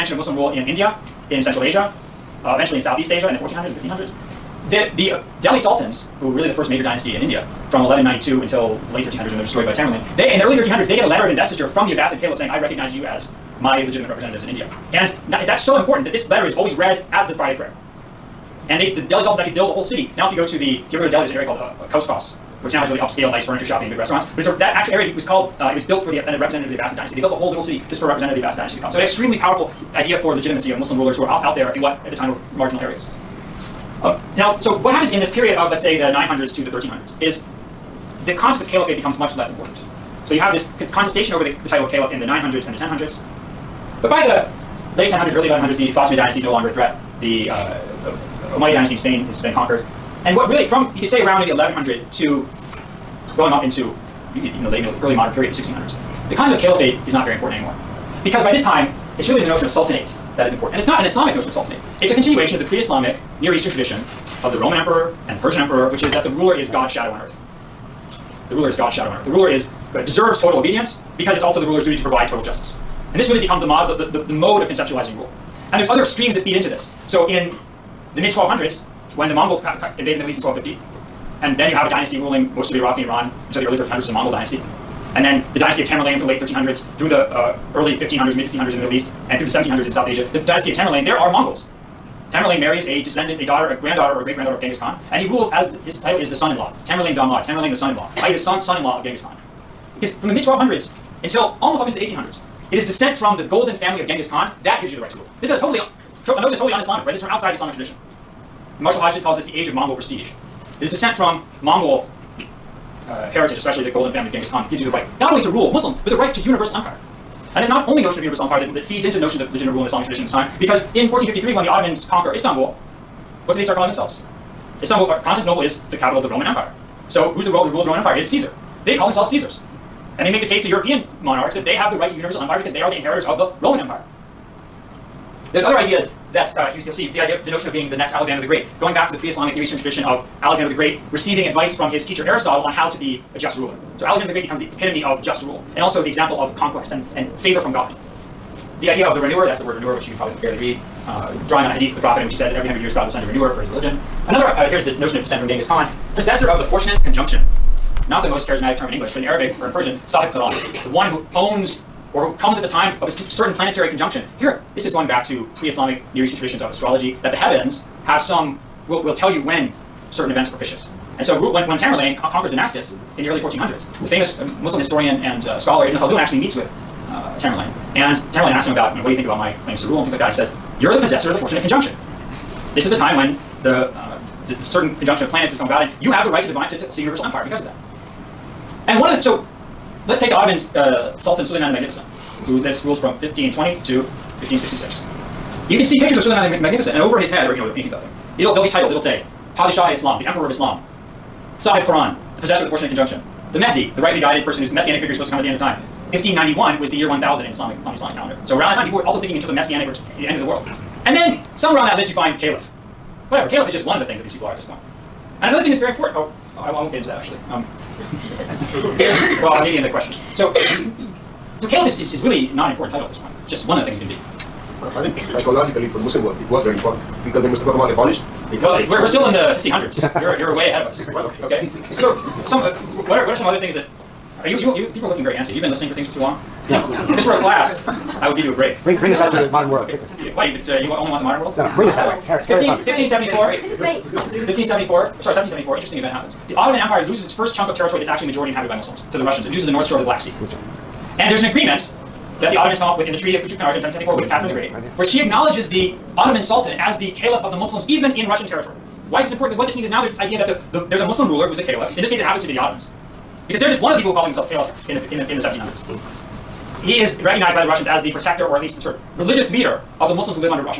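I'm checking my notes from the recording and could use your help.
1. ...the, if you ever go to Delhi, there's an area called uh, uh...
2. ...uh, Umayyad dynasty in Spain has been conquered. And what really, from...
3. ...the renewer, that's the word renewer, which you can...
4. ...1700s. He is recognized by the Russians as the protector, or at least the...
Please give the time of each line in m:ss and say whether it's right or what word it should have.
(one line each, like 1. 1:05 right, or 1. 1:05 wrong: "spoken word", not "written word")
1. 0:20 right
2. 0:47 right
3. 2:29 right
4. 4:25 right.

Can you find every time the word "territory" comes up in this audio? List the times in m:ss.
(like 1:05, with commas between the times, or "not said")
4:07, 4:18.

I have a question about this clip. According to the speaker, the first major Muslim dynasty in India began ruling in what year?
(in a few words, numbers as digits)
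1192.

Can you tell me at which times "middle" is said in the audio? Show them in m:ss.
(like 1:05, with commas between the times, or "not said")
0:54, 1:20, 1:28.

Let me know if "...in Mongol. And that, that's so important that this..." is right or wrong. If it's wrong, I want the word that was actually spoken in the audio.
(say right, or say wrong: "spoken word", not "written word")
wrong: "India", not "Mongol".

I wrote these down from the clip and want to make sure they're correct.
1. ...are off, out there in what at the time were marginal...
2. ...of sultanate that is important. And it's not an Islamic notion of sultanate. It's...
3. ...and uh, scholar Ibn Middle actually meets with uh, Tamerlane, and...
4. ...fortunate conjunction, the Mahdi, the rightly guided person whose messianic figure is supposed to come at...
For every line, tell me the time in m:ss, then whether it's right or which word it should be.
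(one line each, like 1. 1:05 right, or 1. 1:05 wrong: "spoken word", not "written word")
1. 0:31 right
2. 0:59 right
3. 2:55 wrong: "Khaldun", not "Middle"
4. 3:22 right.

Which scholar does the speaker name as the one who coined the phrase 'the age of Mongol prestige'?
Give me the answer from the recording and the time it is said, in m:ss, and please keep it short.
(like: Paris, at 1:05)
Marshall Hodgson, at 1:48.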